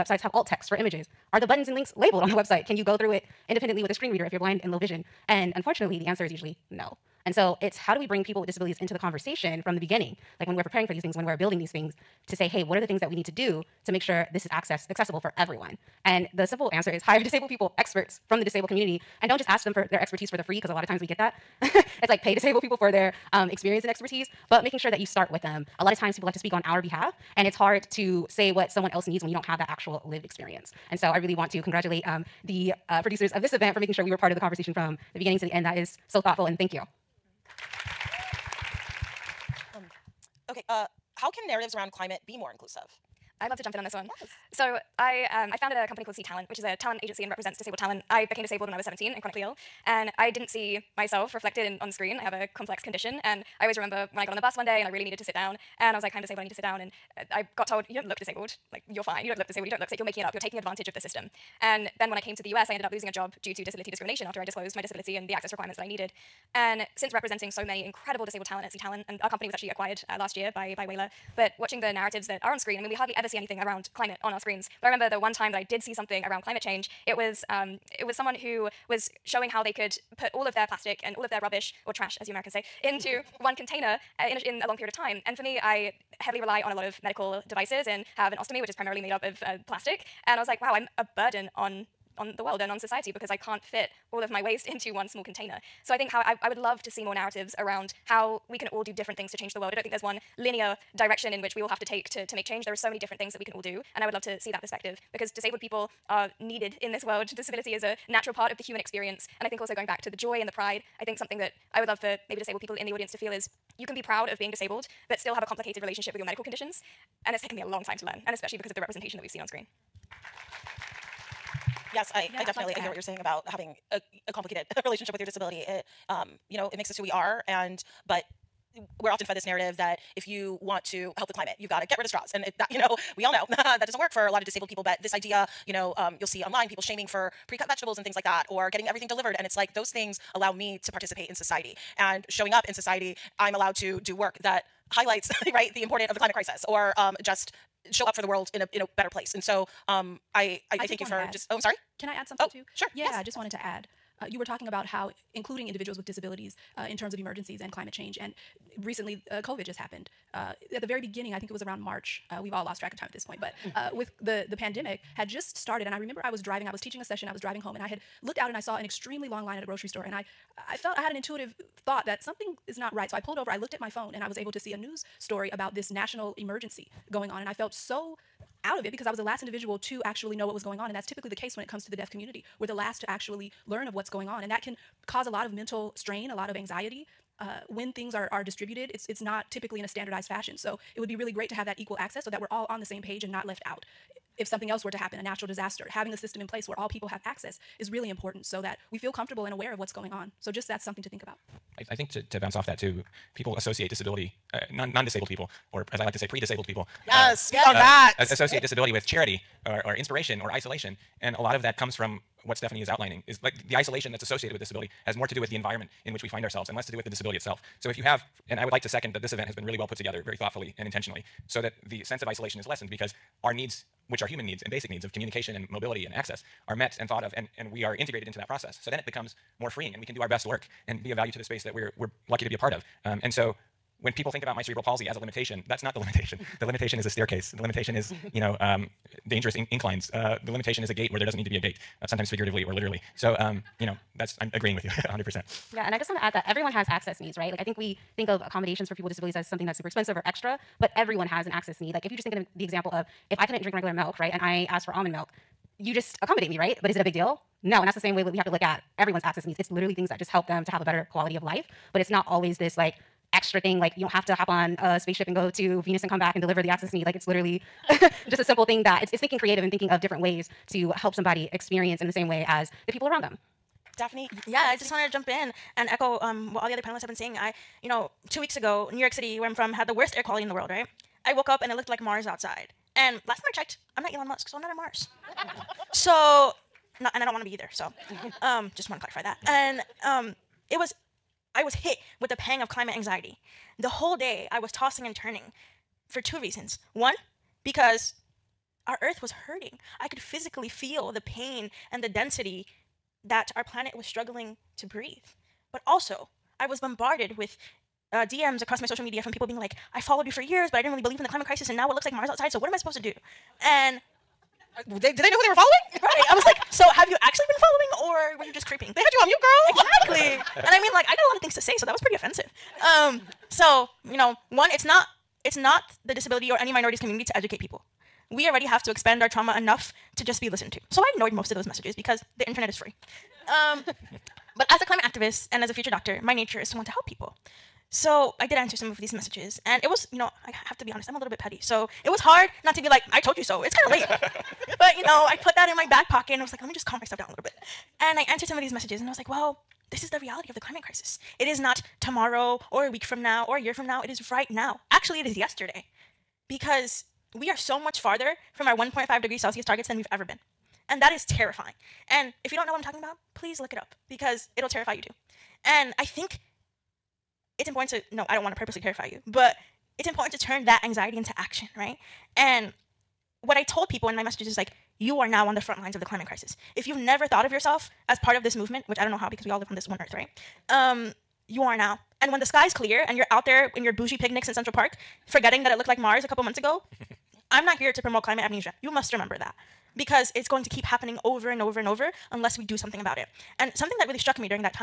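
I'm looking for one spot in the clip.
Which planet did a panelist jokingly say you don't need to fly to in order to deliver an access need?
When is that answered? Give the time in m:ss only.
4:25.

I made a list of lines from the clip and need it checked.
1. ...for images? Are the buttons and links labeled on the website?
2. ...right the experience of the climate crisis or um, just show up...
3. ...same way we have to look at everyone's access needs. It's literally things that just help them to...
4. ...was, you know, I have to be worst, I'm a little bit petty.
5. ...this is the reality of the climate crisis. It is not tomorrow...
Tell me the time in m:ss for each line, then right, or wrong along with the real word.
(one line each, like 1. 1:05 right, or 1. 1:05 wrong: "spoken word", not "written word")
1. 0:00 right
2. 2:25 wrong: "importance", not "experience"
3. 4:18 right
4. 5:39 wrong: "honest", not "worst"
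5. 5:49 right.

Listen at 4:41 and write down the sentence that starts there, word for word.
I woke up and it looked like Mars outside.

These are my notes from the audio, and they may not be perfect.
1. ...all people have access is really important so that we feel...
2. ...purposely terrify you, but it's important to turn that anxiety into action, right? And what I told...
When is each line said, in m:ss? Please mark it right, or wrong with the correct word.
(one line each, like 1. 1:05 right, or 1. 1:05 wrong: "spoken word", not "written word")
1. 3:16 right
2. 6:08 right.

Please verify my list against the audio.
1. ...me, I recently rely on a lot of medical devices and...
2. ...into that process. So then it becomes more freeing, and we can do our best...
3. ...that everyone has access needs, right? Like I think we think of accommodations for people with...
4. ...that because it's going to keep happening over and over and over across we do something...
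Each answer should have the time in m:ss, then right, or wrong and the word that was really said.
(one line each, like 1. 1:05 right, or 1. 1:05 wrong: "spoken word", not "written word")
1. 1:25 wrong: "heavily", not "recently"
2. 3:48 right
3. 4:06 right
4. 6:29 wrong: "unless", not "across".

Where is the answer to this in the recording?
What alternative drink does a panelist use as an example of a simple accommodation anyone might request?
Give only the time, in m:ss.
4:14.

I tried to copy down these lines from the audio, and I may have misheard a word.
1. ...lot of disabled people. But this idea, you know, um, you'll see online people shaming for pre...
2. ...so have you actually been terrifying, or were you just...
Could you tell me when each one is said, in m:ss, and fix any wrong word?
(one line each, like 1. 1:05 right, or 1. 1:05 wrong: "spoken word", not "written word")
1. 2:14 right
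2. 5:16 wrong: "following", not "terrifying".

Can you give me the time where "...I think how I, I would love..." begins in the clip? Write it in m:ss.
1:35.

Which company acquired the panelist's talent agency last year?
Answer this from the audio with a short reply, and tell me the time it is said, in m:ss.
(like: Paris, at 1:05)
Whalar, at 1:10.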